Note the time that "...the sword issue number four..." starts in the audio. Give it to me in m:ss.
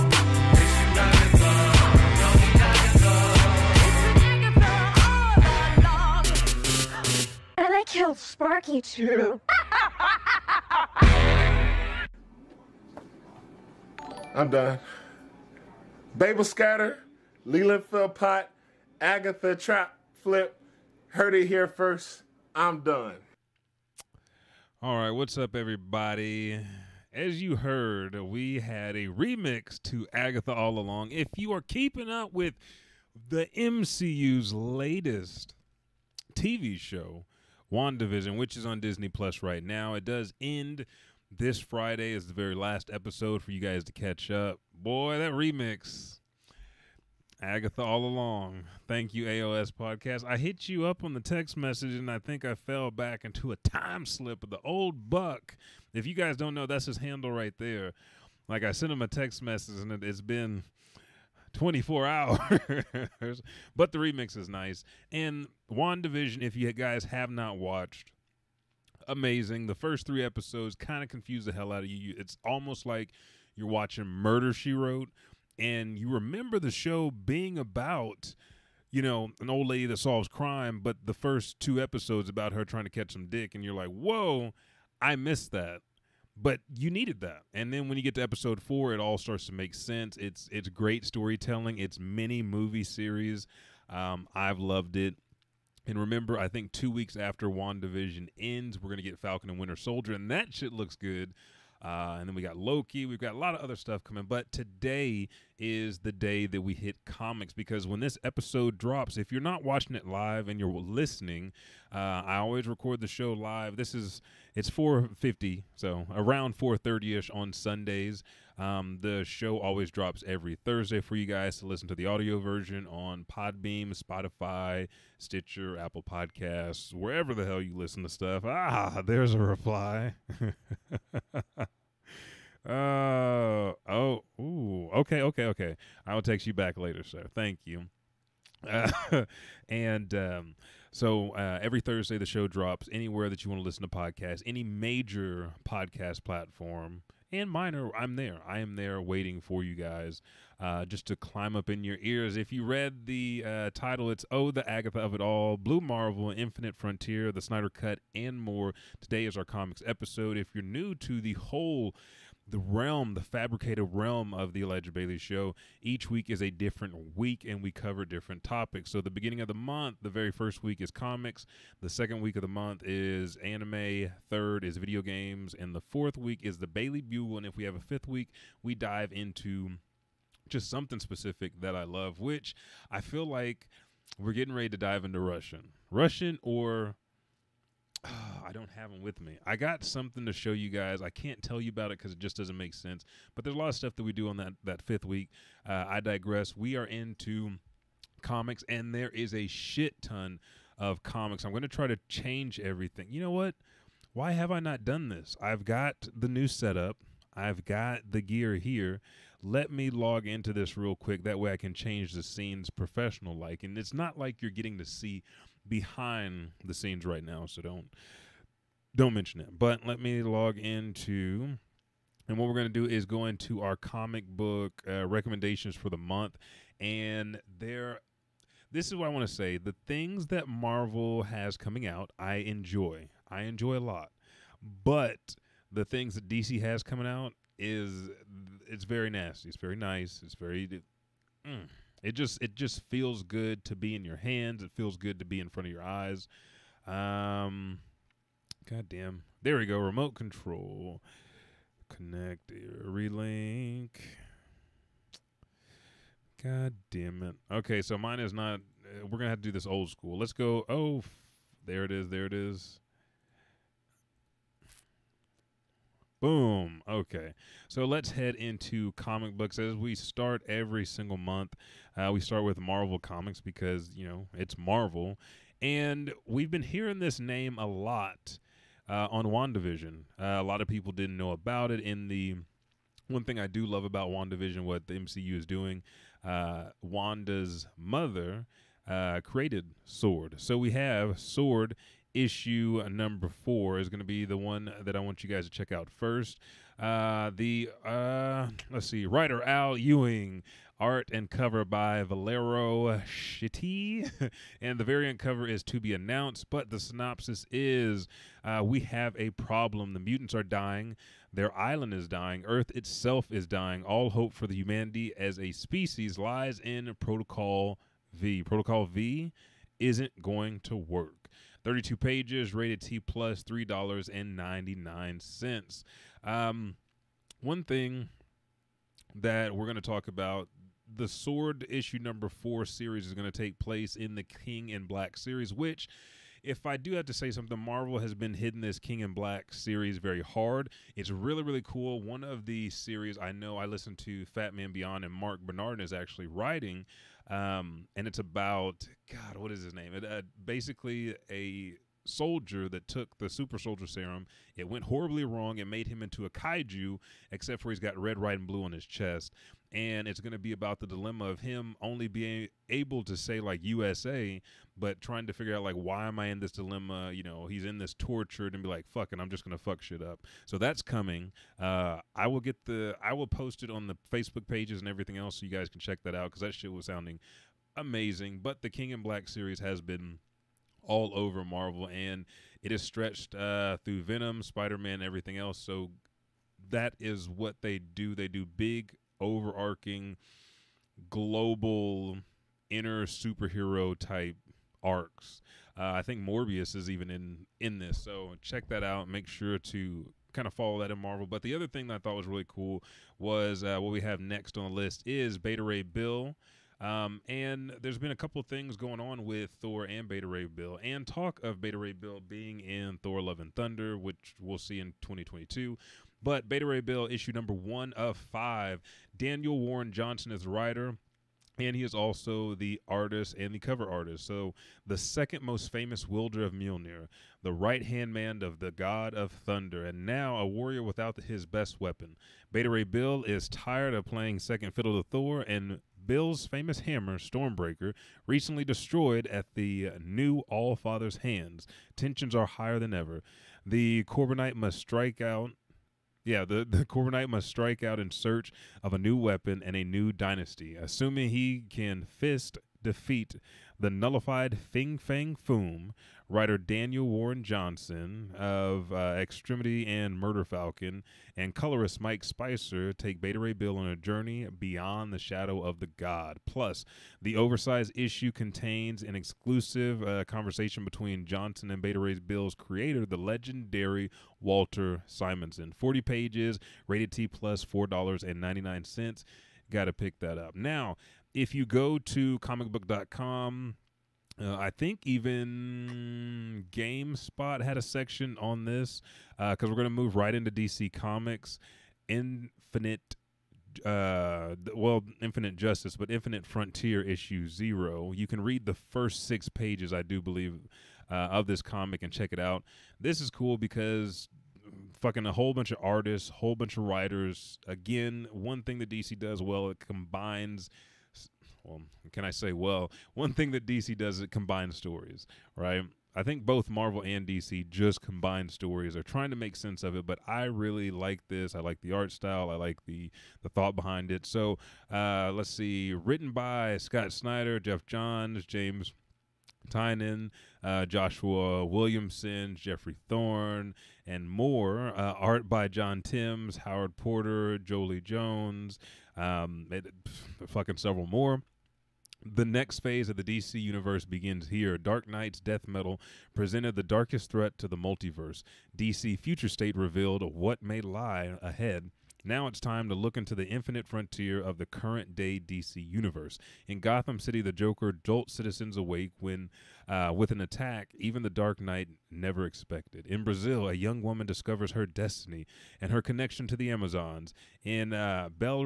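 5:30.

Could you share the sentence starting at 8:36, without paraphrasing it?
I think both Marvel and DC just combine stories.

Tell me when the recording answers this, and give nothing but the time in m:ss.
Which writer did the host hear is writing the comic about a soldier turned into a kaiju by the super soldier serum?
5:45.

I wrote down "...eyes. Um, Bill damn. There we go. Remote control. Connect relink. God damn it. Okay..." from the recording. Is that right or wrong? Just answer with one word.
wrong.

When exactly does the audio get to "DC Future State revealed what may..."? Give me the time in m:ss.
9:08.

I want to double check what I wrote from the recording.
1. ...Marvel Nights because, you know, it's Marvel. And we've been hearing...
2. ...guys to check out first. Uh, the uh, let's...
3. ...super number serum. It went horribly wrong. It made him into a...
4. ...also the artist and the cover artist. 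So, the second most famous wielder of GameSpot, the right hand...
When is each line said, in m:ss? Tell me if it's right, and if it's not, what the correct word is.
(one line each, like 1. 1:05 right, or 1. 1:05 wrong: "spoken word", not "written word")
1. 4:32 wrong: "Comics", not "Nights"
2. 4:55 right
3. 5:53 wrong: "soldier", not "number"
4. 7:01 wrong: "Mjolnir", not "GameSpot".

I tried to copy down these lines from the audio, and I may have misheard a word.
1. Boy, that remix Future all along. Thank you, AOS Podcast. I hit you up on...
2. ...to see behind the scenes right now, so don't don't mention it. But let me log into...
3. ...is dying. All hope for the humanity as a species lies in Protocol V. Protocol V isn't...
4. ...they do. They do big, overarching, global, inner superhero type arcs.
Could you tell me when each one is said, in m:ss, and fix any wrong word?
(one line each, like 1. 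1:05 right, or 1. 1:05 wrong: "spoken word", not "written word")
1. 0:44 wrong: "Agatha", not "Future"
2. 3:34 right
3. 5:13 right
4. 6:27 right.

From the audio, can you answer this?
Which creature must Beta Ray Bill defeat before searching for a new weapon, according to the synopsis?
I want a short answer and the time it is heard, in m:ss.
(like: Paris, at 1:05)
Fing Fang Foom, at 7:34.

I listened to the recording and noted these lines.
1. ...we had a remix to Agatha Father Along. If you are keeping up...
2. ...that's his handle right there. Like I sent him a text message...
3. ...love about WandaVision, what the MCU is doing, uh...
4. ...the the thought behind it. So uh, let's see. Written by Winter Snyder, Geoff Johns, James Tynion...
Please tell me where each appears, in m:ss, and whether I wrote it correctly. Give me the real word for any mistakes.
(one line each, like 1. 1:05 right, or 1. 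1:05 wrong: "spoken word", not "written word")
1. 0:28 wrong: "All", not "Father"
2. 0:56 right
3. 4:43 right
4. 8:42 wrong: "Scott", not "Winter".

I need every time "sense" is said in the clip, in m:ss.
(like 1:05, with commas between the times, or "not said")
1:29, 3:12, 8:39.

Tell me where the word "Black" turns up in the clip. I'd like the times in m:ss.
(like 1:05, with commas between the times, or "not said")
5:34, 5:39, 6:19.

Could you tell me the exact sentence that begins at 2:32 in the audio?
If you read the uh, title, it's Oh, the Agatha of It All, Blue Marvel, Infinite Frontier, The Snyder Cut, and more.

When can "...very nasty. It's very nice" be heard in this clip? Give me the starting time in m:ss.
3:58.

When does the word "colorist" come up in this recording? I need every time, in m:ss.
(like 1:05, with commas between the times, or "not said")
7:41.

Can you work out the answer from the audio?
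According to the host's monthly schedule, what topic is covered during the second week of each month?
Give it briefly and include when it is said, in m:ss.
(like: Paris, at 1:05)
anime, at 2:53.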